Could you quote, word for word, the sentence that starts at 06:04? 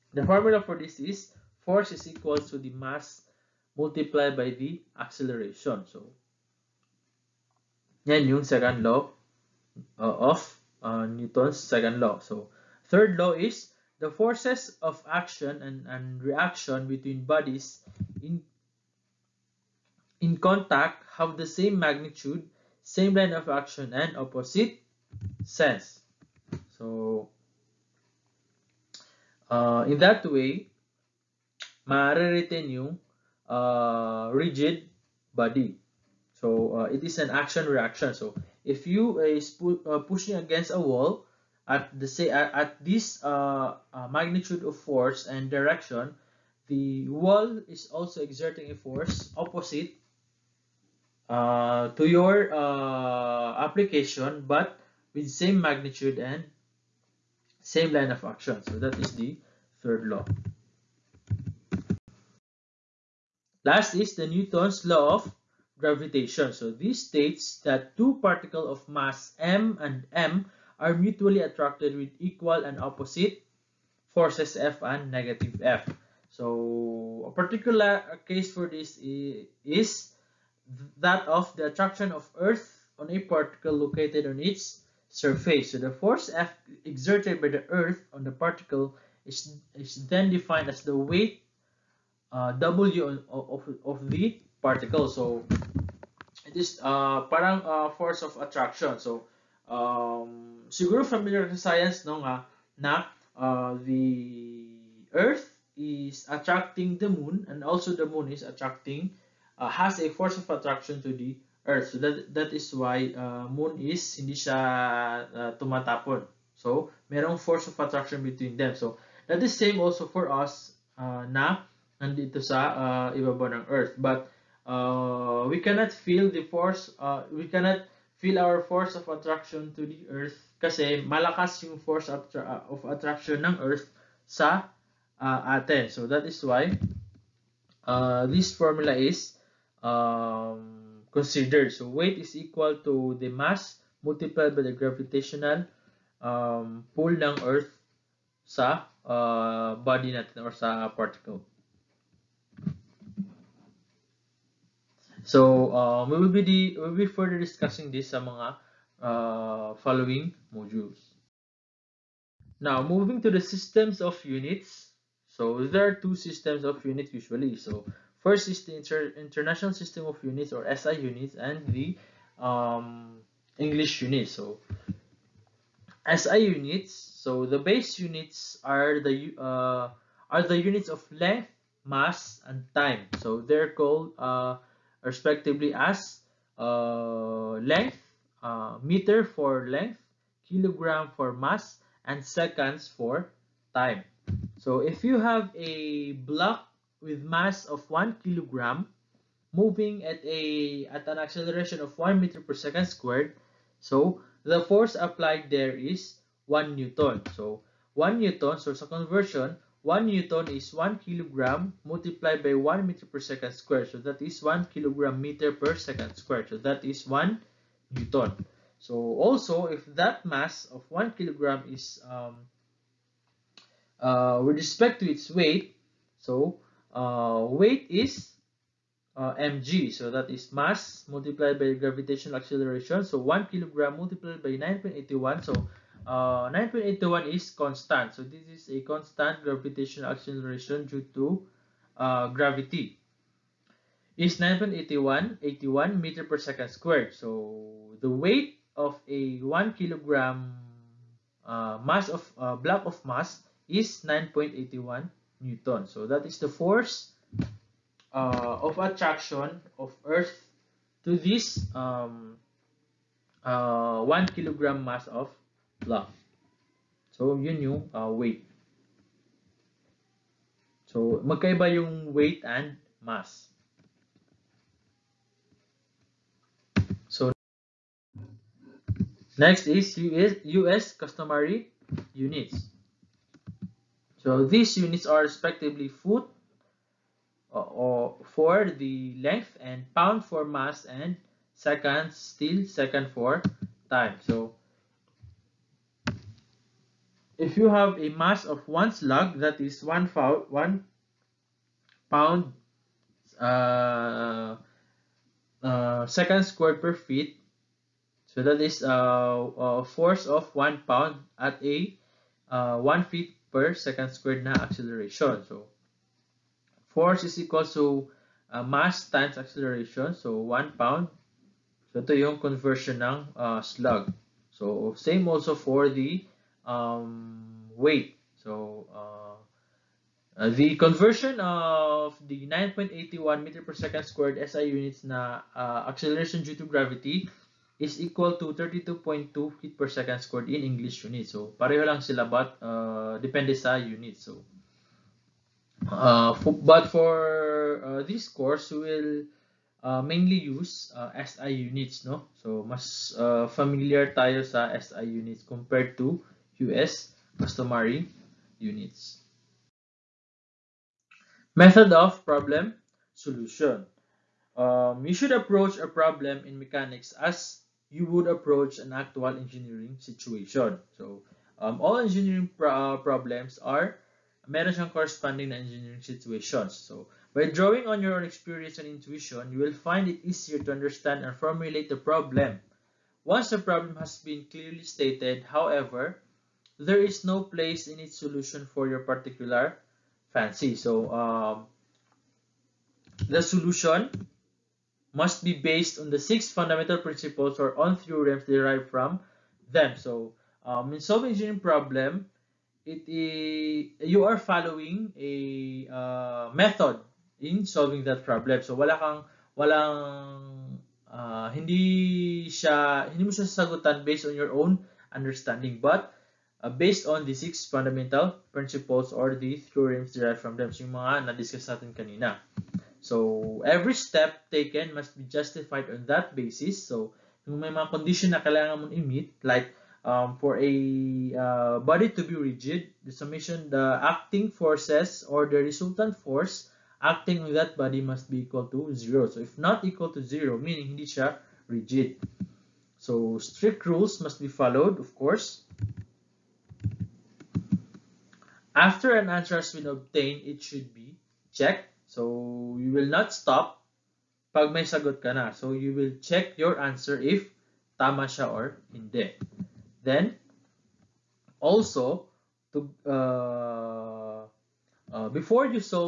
Um, you should approach a problem in mechanics as you would approach an actual engineering situation.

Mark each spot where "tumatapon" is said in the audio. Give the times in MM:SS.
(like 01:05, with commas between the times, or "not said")
01:55.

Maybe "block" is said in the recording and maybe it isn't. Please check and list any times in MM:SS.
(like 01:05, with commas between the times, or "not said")
03:16, 04:12.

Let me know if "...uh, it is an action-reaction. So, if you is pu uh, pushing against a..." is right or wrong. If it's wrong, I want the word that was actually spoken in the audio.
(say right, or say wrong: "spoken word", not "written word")
right.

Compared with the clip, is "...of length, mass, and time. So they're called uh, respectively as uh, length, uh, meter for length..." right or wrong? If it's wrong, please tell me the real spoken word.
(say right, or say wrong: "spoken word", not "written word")
right.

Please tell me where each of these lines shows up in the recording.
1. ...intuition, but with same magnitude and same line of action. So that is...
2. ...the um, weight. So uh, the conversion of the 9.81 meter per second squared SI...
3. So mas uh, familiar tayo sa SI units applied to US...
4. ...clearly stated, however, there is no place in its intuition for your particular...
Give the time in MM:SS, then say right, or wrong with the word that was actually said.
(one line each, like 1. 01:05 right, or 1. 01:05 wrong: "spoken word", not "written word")
1. 00:53 wrong: "application", not "intuition"
2. 05:25 right
3. 05:52 wrong: "compared", not "applied"
4. 06:24 wrong: "solution", not "intuition".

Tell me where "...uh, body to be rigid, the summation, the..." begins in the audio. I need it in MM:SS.
07:11.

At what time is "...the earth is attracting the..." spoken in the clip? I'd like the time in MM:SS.
01:43.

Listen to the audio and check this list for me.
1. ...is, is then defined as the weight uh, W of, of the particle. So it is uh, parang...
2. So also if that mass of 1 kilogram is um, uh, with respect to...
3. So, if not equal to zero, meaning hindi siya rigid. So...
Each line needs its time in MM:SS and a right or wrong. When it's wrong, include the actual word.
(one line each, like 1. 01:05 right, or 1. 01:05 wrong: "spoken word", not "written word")
1. 01:29 right
2. 03:38 right
3. 07:19 right.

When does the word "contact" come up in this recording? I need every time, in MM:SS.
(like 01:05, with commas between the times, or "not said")
00:20.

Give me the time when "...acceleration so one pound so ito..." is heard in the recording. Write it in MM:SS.
05:19.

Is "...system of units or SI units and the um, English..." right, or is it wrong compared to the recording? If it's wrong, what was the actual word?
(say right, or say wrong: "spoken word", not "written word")
right.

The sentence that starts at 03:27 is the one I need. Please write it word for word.
So 1 newton, so it's a conversion 1 newton is 1 kilogram multiplied by 1 meter per second squared.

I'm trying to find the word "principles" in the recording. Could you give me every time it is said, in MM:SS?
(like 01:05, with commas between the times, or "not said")
06:36, 06:58.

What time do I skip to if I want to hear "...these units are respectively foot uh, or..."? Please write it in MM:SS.
04:44.